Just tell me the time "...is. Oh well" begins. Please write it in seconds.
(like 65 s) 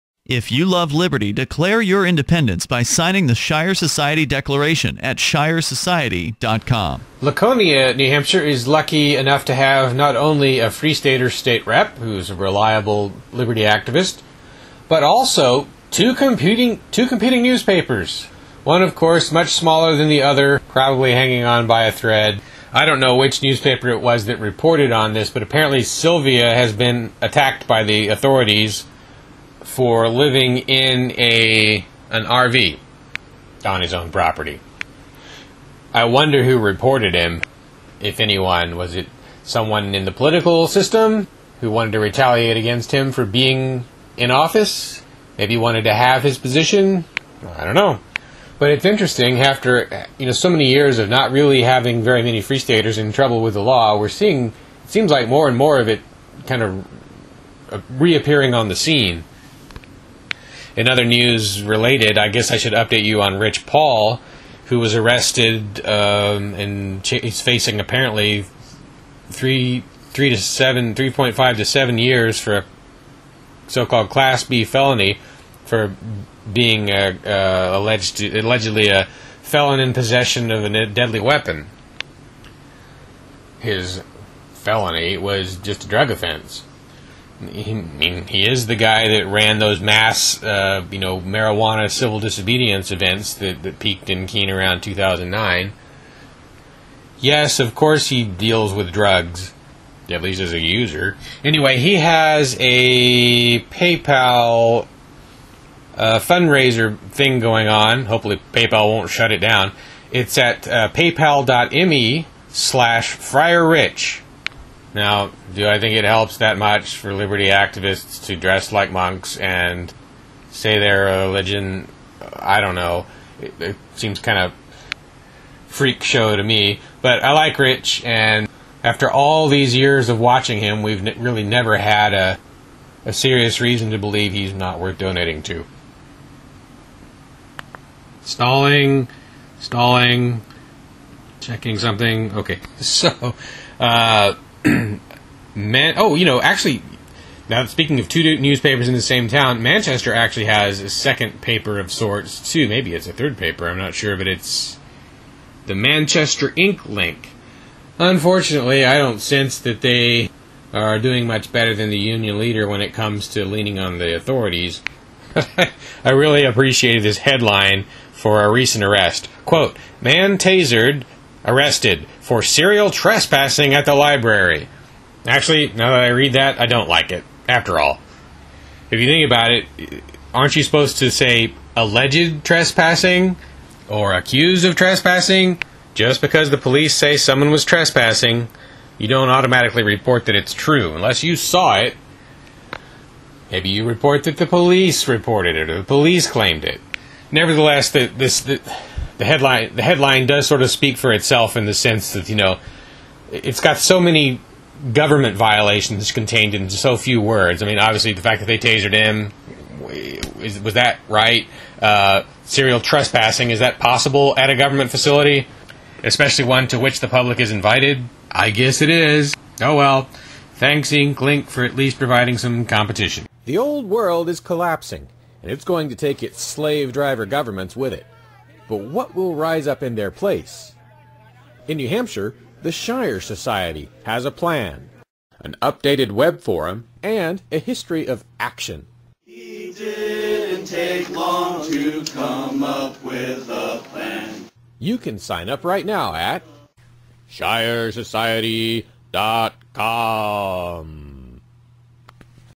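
218 s.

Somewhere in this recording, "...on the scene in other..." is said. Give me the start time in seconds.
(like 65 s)
58 s.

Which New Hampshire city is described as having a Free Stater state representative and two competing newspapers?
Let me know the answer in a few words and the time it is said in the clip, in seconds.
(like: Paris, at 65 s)
Laconia, at 7 s.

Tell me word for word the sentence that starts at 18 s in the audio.
One, of course, much smaller than the other, probably hanging on by a thread.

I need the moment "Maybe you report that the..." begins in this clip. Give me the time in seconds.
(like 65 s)
193 s.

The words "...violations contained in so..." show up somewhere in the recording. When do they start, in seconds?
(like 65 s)
205 s.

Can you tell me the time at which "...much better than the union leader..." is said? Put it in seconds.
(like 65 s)
161 s.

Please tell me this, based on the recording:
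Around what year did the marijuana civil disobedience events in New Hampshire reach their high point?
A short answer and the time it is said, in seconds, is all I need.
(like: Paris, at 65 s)
2009, at 94 s.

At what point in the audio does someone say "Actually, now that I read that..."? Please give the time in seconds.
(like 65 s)
175 s.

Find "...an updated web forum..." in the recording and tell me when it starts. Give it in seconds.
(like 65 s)
235 s.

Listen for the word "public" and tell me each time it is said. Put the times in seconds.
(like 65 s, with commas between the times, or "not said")
217 s.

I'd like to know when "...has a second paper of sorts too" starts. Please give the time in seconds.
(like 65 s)
150 s.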